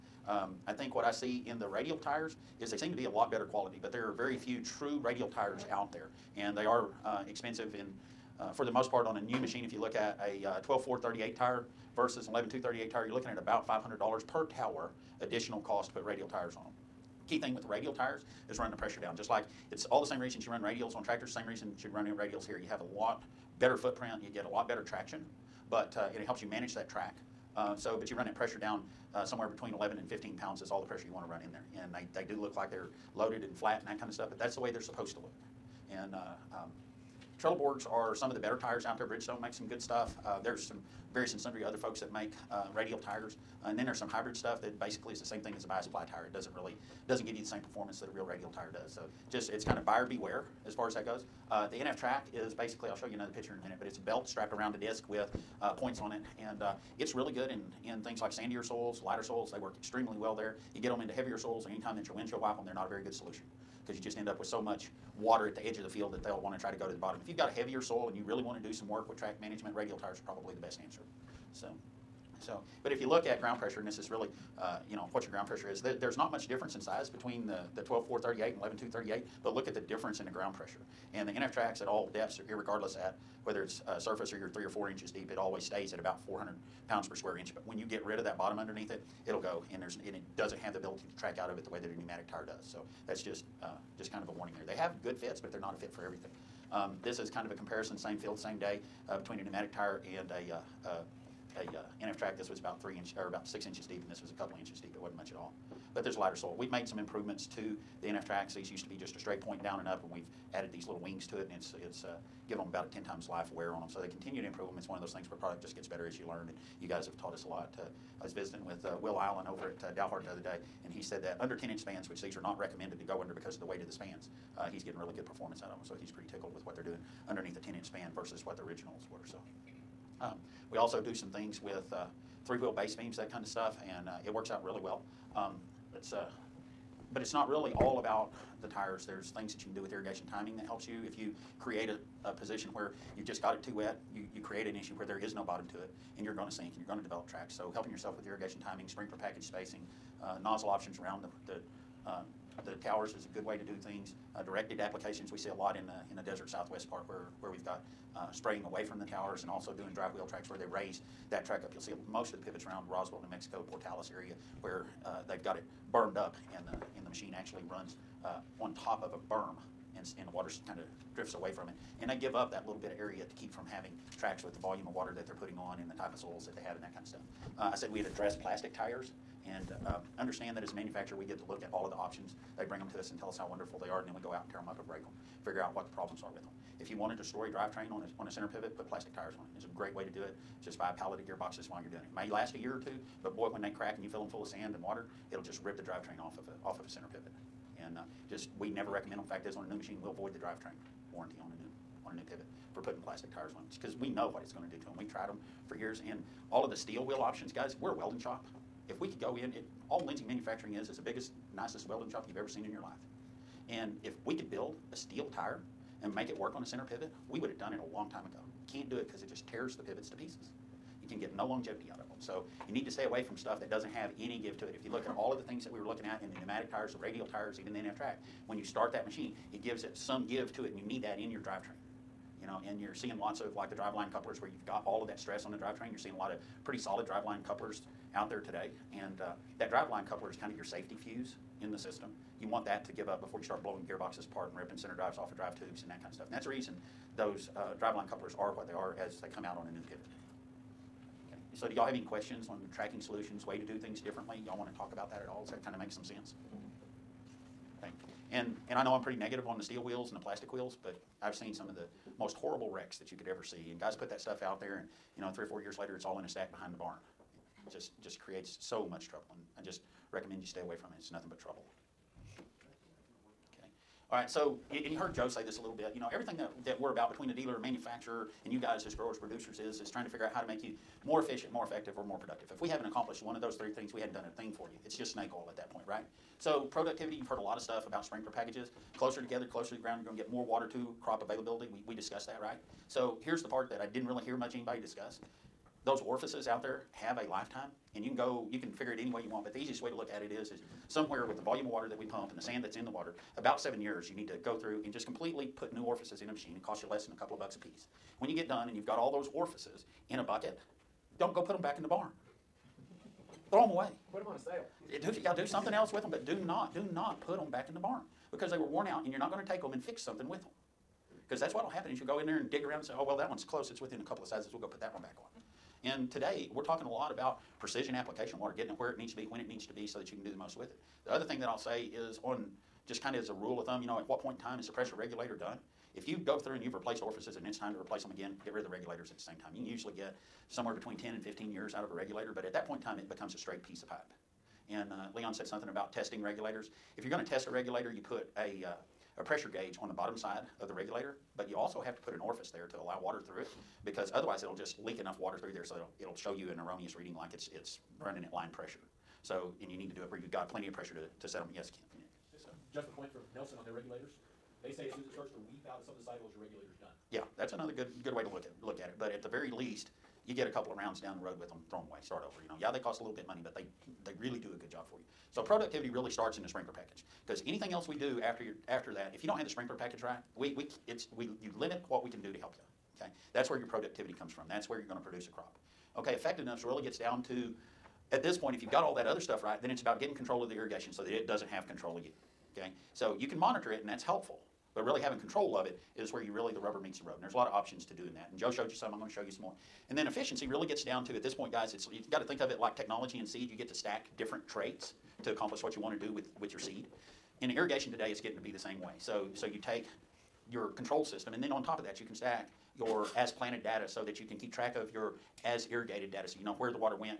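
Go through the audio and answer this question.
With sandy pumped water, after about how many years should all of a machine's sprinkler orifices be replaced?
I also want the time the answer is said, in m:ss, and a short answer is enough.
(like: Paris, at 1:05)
7 years, at 5:03.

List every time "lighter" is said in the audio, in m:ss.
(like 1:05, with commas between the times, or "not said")
0:59, 1:46.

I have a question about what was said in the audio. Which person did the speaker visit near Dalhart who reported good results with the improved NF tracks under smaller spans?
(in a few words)
Will Allen.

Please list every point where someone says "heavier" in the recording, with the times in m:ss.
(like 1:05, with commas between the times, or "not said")
1:01, 1:07.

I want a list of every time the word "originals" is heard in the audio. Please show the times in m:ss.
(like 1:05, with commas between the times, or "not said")
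2:08.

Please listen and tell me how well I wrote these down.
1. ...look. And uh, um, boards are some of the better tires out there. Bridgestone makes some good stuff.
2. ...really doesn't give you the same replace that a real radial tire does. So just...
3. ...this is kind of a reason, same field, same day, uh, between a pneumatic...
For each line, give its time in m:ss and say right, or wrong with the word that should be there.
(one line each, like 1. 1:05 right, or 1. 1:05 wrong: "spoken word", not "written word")
1. 0:35 right
2. 0:46 wrong: "performance", not "replace"
3. 1:37 wrong: "comparison", not "reason".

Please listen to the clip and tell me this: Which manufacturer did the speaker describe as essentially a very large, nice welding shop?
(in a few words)
Lindsay Manufacturing.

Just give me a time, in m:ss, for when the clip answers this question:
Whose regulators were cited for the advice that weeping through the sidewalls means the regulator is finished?
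6:03.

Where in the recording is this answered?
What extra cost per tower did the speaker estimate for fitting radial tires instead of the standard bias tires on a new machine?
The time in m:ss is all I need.
0:13.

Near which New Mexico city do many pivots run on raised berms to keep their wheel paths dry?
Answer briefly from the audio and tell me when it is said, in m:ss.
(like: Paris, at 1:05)
Roswell, at 2:42.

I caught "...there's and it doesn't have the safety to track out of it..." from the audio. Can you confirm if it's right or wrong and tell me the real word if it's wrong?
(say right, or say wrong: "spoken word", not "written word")
wrong: "ability", not "safety".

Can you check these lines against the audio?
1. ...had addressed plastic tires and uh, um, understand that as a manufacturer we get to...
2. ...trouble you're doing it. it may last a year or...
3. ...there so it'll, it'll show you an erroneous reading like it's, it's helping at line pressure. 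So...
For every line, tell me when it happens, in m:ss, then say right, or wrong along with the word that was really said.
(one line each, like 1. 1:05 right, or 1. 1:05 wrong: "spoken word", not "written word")
1. 2:57 right
2. 3:11 wrong: "while", not "trouble"
3. 5:55 wrong: "running", not "helping".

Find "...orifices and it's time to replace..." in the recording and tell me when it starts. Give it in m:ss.
5:37.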